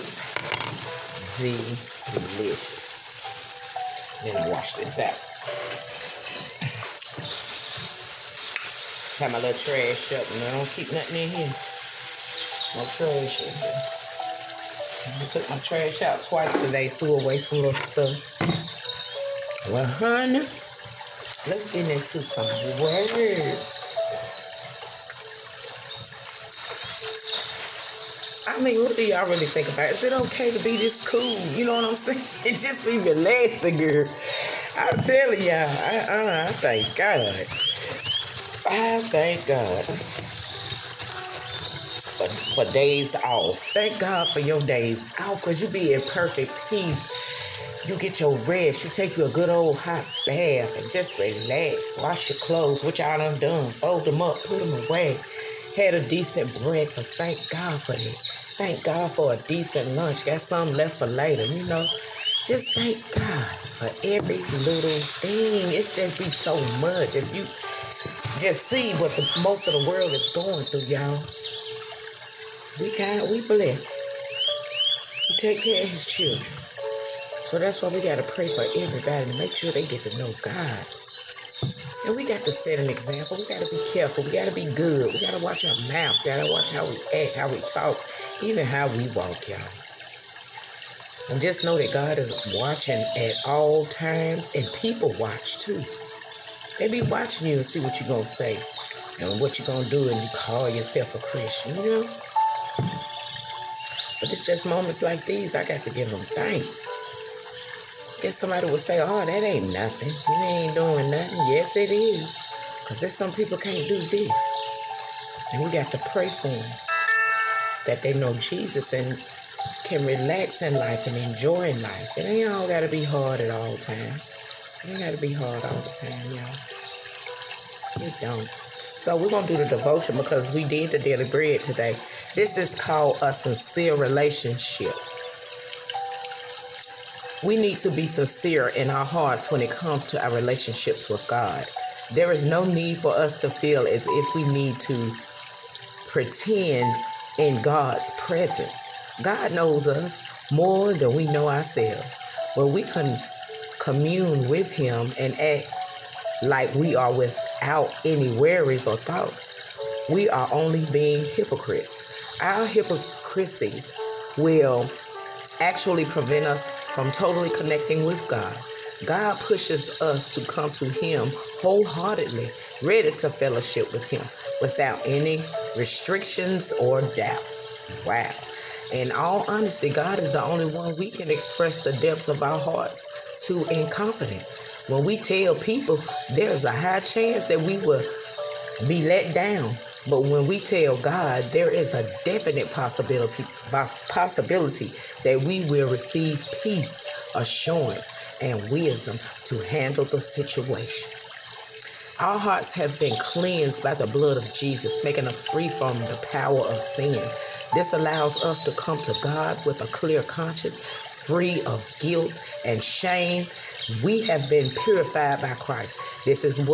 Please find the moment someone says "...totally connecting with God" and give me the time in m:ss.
2:47.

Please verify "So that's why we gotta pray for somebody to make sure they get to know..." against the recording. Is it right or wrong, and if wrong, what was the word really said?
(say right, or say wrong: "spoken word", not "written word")
wrong: "everybody", not "somebody".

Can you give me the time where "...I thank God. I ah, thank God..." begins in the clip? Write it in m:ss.
0:36.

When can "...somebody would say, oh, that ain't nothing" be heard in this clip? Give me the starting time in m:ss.
1:48.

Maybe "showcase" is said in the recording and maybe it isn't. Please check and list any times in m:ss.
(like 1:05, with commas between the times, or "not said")
not said.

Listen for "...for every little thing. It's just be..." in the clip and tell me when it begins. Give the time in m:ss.
1:03.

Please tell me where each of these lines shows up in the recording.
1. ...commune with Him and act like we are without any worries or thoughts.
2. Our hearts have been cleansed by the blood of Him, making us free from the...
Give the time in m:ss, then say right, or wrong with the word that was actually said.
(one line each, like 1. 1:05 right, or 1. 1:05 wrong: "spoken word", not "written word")
1. 2:33 right
2. 3:22 wrong: "Jesus", not "Him".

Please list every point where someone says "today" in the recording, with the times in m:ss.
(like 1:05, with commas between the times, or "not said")
0:16, 2:11.